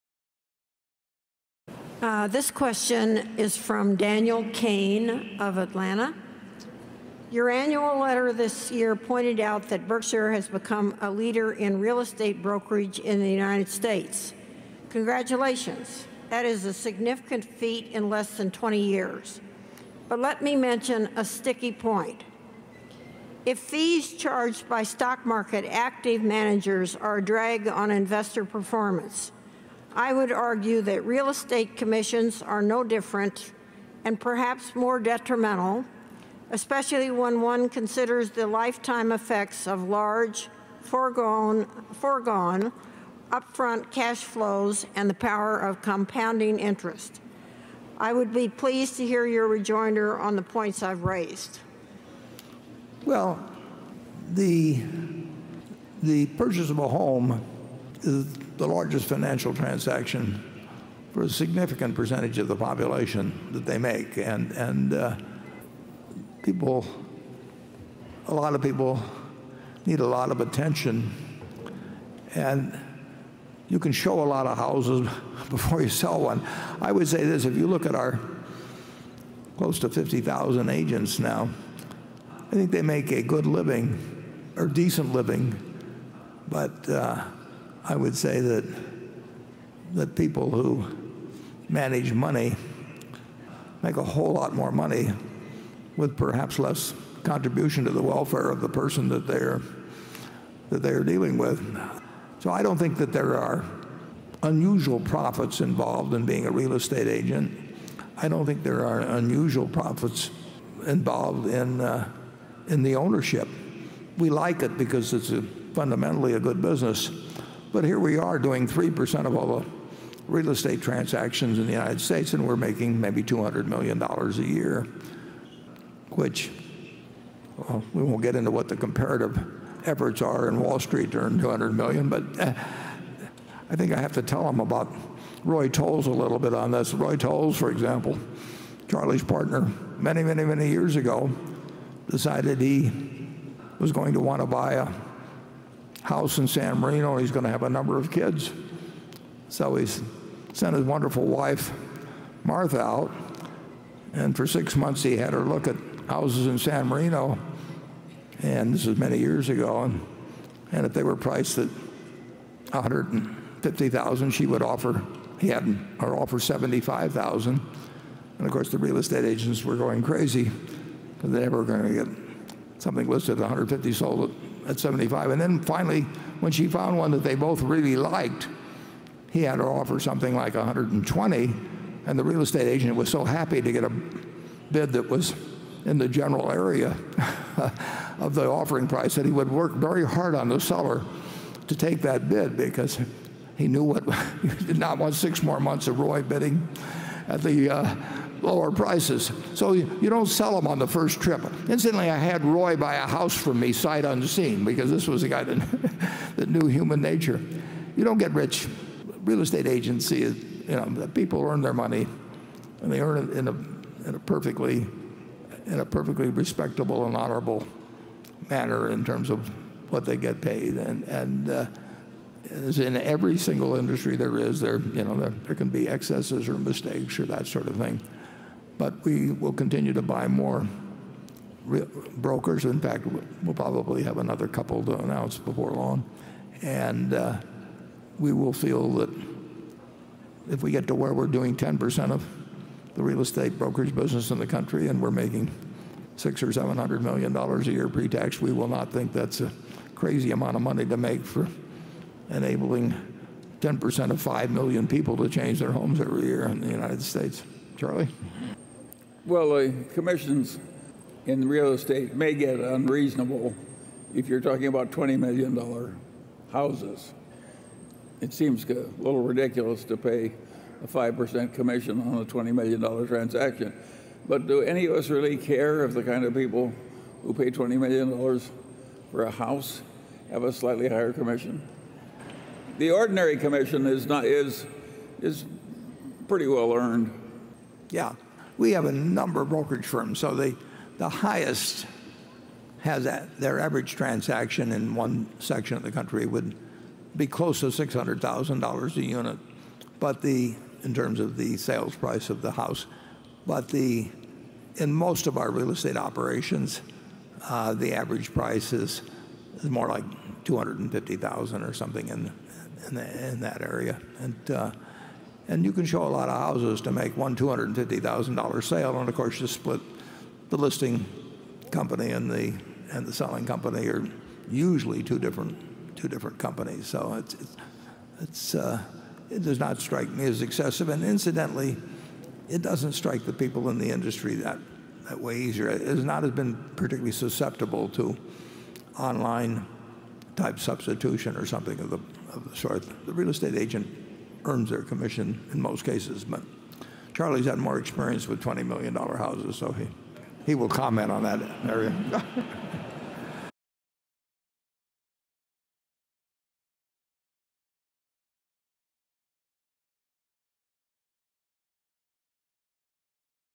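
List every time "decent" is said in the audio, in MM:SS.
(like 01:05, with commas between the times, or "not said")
01:24.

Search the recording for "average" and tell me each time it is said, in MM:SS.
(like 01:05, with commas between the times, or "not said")
04:53, 05:07.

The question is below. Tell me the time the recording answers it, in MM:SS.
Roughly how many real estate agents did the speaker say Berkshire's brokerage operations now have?
01:19.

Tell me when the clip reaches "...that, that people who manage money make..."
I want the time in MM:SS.
01:28.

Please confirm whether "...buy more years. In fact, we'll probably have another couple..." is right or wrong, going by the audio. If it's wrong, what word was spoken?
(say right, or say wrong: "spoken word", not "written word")
wrong: "brokers", not "years".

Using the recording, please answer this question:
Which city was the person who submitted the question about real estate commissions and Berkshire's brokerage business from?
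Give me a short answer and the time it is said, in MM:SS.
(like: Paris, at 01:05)
Atlanta, at 00:05.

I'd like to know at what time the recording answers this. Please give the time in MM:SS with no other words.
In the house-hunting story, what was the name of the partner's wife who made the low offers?
02:32.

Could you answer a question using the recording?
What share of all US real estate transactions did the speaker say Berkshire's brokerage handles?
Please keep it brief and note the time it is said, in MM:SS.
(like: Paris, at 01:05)
3%, at 01:58.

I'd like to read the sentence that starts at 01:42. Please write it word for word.
So I don't think that there are unusual profits involved in being a real estate agent.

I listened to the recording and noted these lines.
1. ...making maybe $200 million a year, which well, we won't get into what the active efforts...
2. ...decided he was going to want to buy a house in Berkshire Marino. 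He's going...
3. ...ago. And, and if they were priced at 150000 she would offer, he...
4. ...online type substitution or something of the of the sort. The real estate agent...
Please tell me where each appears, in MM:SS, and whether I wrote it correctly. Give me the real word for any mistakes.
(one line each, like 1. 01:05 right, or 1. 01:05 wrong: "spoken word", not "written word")
1. 02:02 wrong: "comparative", not "active"
2. 02:22 wrong: "San", not "Berkshire"
3. 02:39 right
4. 05:38 right.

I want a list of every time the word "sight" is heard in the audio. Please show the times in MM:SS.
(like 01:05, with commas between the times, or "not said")
03:23.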